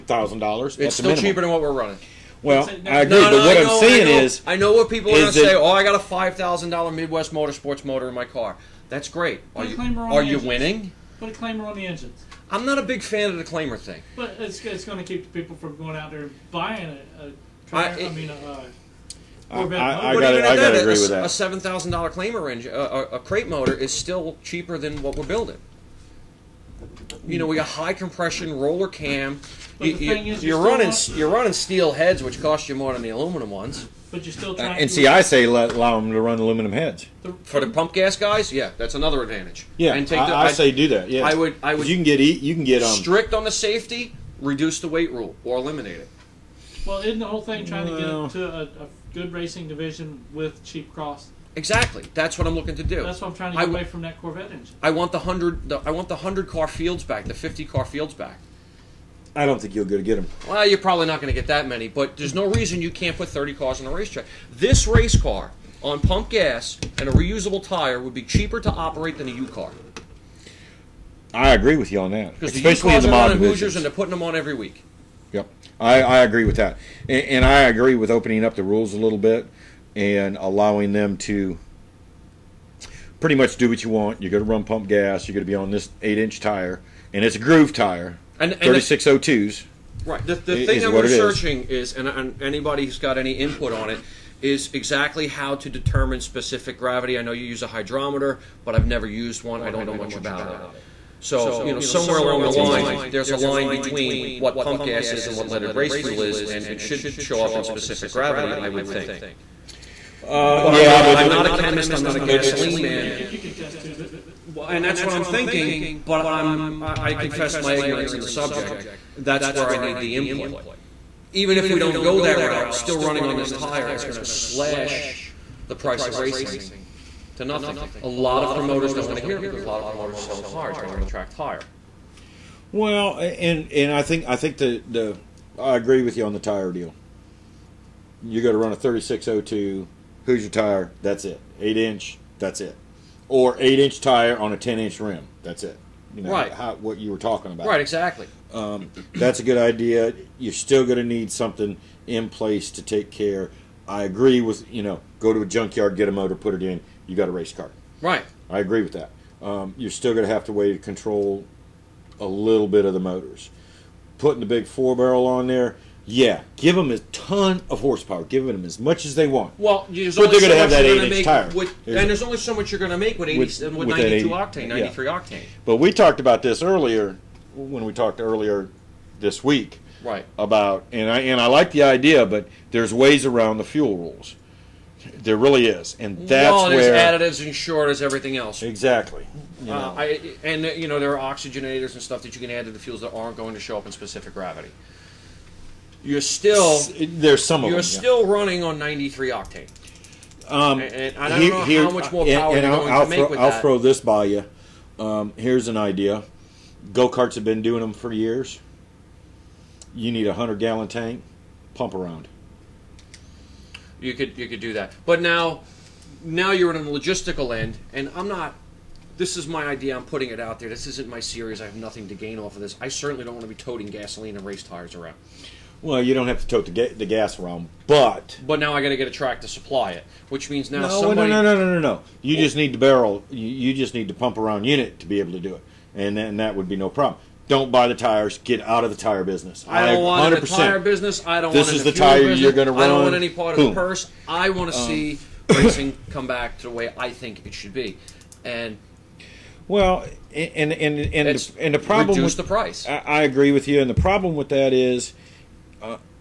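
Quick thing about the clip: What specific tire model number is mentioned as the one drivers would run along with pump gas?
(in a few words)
3602.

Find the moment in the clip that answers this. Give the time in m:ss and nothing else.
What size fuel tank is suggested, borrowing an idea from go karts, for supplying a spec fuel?
3:30.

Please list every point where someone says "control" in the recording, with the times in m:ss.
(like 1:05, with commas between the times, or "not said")
2:40.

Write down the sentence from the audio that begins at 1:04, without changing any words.
This race car on pump gas and a reusable tire would be cheaper to operate than a U car.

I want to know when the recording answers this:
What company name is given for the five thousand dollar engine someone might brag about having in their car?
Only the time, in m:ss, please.
0:06.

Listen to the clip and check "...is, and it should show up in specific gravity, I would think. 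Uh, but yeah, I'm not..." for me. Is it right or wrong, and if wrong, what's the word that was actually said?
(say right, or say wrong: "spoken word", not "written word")
right.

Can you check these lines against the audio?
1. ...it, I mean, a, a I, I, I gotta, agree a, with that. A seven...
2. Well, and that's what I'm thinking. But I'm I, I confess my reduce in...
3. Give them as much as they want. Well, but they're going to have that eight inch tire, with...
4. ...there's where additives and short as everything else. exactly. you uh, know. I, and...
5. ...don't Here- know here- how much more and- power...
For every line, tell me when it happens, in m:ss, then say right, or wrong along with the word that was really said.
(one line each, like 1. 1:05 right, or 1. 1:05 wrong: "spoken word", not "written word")
1. 0:17 right
2. 1:54 wrong: "ignorance", not "reduce"
3. 2:48 right
4. 3:06 right
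5. 3:21 right.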